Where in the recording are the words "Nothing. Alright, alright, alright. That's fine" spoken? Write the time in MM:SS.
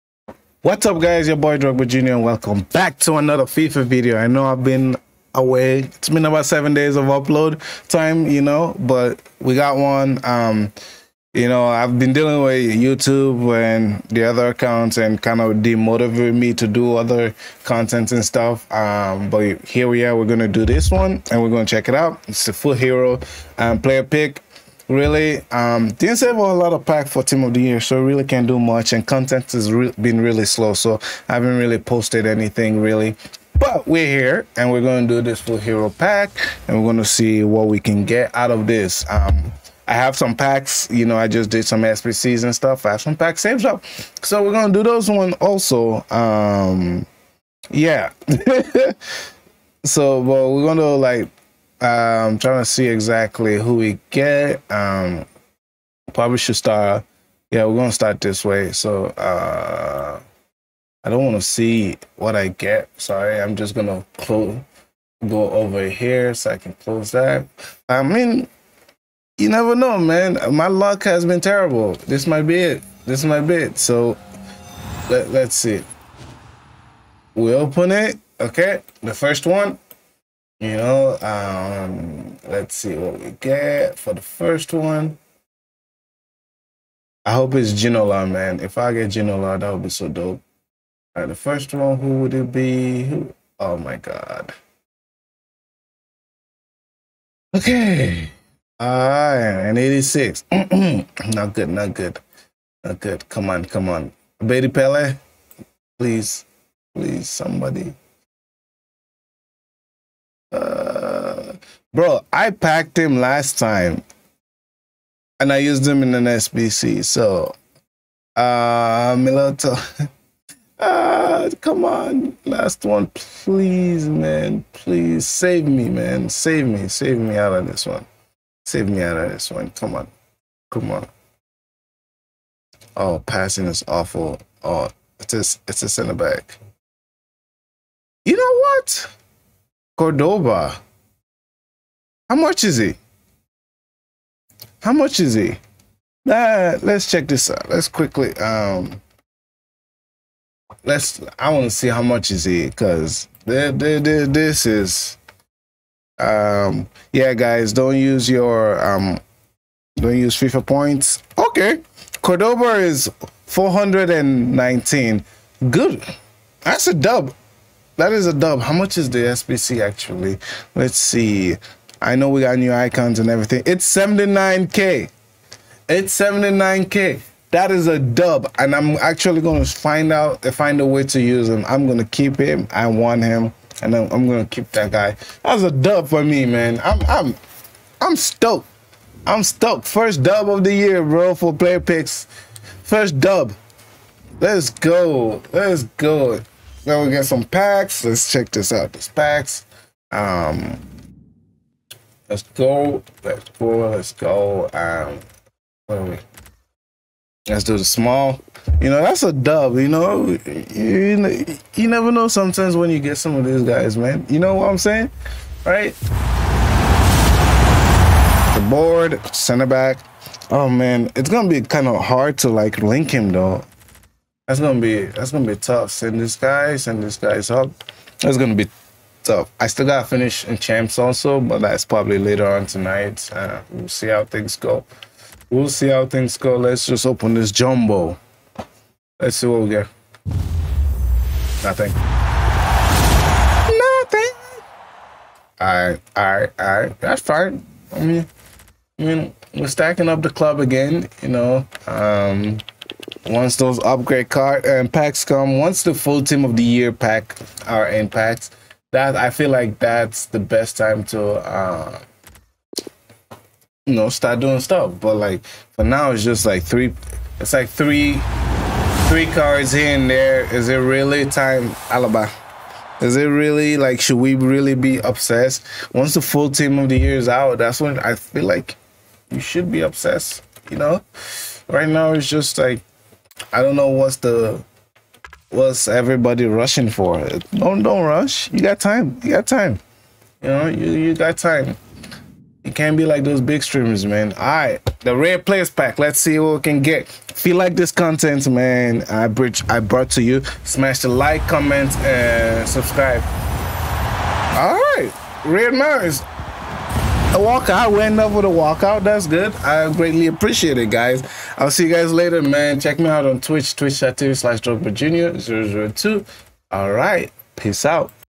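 04:03.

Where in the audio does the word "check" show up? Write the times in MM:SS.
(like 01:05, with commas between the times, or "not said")
00:21, 02:27, 03:18, 05:12.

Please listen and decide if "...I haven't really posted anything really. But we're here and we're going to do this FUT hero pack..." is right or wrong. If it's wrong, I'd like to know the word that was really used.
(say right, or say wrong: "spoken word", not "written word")
right.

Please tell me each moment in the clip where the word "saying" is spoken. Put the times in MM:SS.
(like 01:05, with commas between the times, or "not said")
03:34.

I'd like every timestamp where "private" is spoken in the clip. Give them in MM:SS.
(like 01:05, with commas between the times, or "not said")
not said.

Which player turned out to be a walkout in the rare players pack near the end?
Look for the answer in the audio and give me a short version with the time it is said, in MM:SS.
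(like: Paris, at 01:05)
Red Mars, at 05:05.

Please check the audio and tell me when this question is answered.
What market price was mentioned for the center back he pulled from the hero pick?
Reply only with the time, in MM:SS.
02:43.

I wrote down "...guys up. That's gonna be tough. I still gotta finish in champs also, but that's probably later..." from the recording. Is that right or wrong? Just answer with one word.
right.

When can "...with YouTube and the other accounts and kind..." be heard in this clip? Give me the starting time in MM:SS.
00:12.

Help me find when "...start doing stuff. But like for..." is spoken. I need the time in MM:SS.
04:24.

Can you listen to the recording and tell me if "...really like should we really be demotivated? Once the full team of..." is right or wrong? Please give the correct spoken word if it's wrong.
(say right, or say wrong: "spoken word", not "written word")
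wrong: "obsessed", not "demotivated".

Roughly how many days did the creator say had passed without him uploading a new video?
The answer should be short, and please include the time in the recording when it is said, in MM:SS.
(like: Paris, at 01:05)
7, at 00:06.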